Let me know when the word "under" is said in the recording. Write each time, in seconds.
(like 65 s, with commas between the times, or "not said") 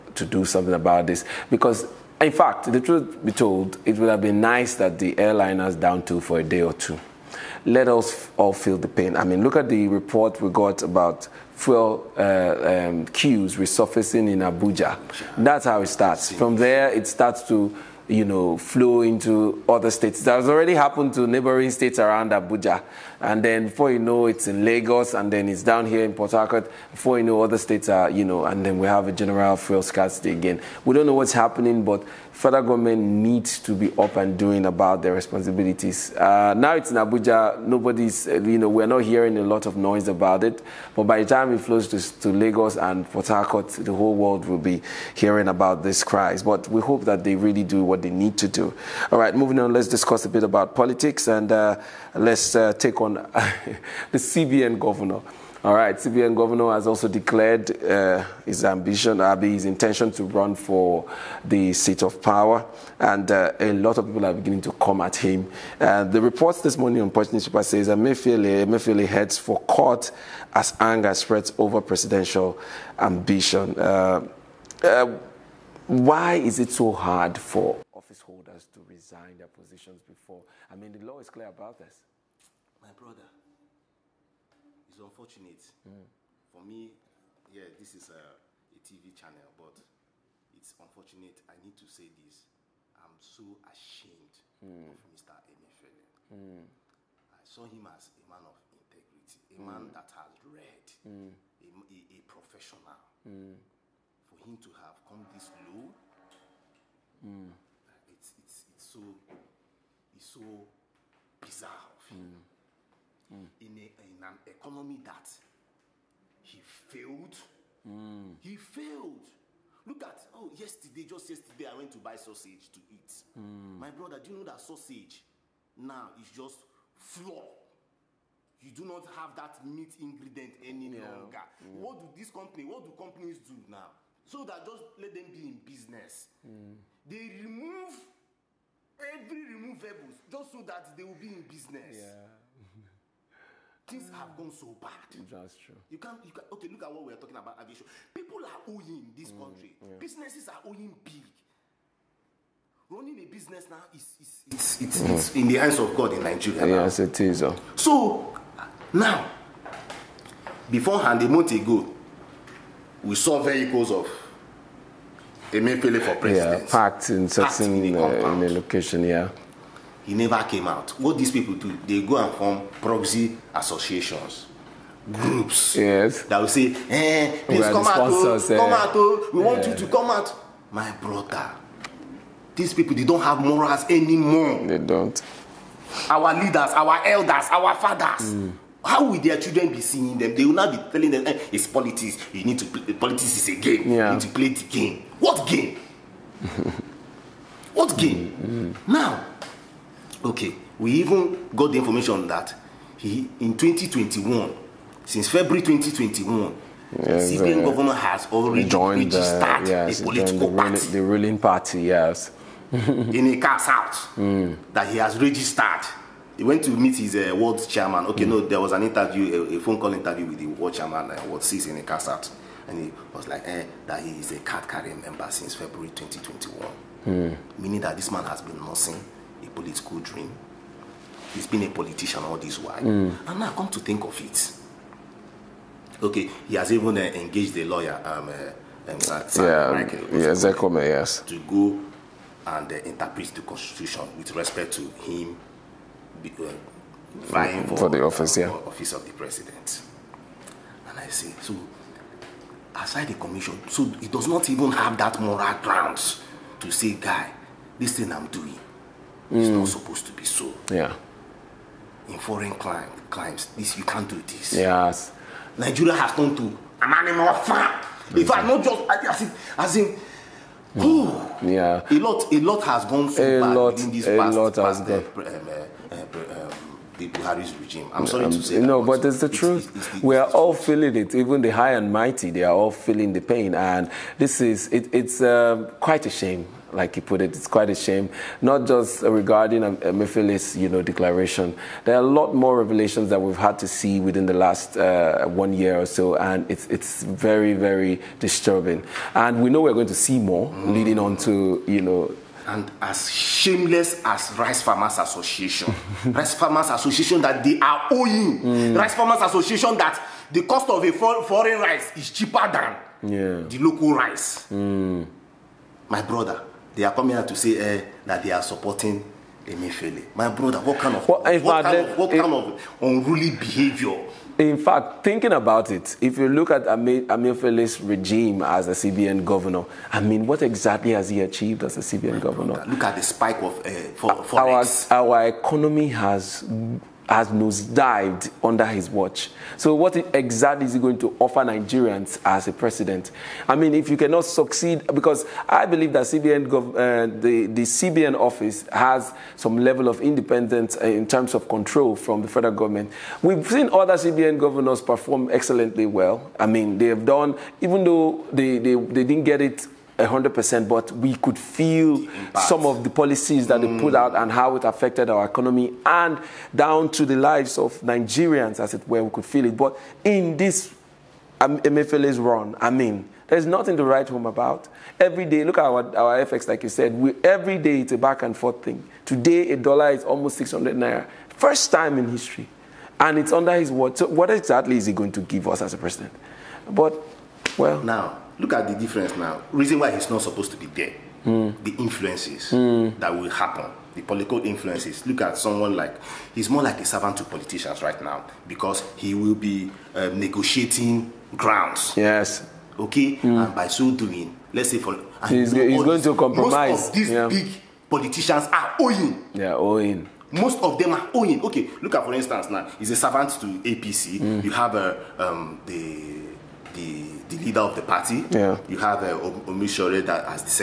338 s, 383 s.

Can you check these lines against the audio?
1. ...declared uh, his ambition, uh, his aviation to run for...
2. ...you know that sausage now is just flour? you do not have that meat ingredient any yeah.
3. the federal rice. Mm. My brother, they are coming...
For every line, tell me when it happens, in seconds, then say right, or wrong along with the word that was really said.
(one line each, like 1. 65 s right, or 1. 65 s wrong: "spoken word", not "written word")
1. 57 s wrong: "intention", not "aviation"
2. 124 s right
3. 313 s wrong: "local", not "federal".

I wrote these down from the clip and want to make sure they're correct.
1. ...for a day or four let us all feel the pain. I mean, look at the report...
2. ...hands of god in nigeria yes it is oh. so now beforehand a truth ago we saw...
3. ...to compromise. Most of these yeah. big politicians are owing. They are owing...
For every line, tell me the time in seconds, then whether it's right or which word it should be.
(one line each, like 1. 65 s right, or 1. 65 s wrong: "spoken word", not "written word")
1. 6 s wrong: "two", not "four"
2. 155 s wrong: "month", not "truth"
3. 406 s right.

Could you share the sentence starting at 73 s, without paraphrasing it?
Uh, uh, why is it so hard for office holders to resign their positions before?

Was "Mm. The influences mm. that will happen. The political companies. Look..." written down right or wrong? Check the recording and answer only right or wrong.
wrong.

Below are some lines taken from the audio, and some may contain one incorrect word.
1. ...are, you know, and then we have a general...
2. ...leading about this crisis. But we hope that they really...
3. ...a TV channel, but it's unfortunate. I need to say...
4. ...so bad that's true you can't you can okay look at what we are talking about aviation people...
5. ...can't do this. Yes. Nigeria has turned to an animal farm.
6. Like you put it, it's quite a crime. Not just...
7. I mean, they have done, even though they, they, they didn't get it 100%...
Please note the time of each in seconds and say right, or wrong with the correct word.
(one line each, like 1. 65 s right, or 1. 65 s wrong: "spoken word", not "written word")
1. 27 s right
2. 45 s wrong: "hearing", not "leading"
3. 88 s right
4. 144 s right
5. 263 s right
6. 286 s wrong: "shame", not "crime"
7. 356 s right.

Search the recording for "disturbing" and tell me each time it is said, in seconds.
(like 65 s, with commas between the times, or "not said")
298 s.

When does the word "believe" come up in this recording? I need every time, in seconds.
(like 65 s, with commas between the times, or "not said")
345 s.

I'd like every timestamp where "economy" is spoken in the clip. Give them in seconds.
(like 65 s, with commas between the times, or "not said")
114 s, 335 s, 365 s.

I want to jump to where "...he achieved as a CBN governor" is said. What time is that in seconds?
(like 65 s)
331 s.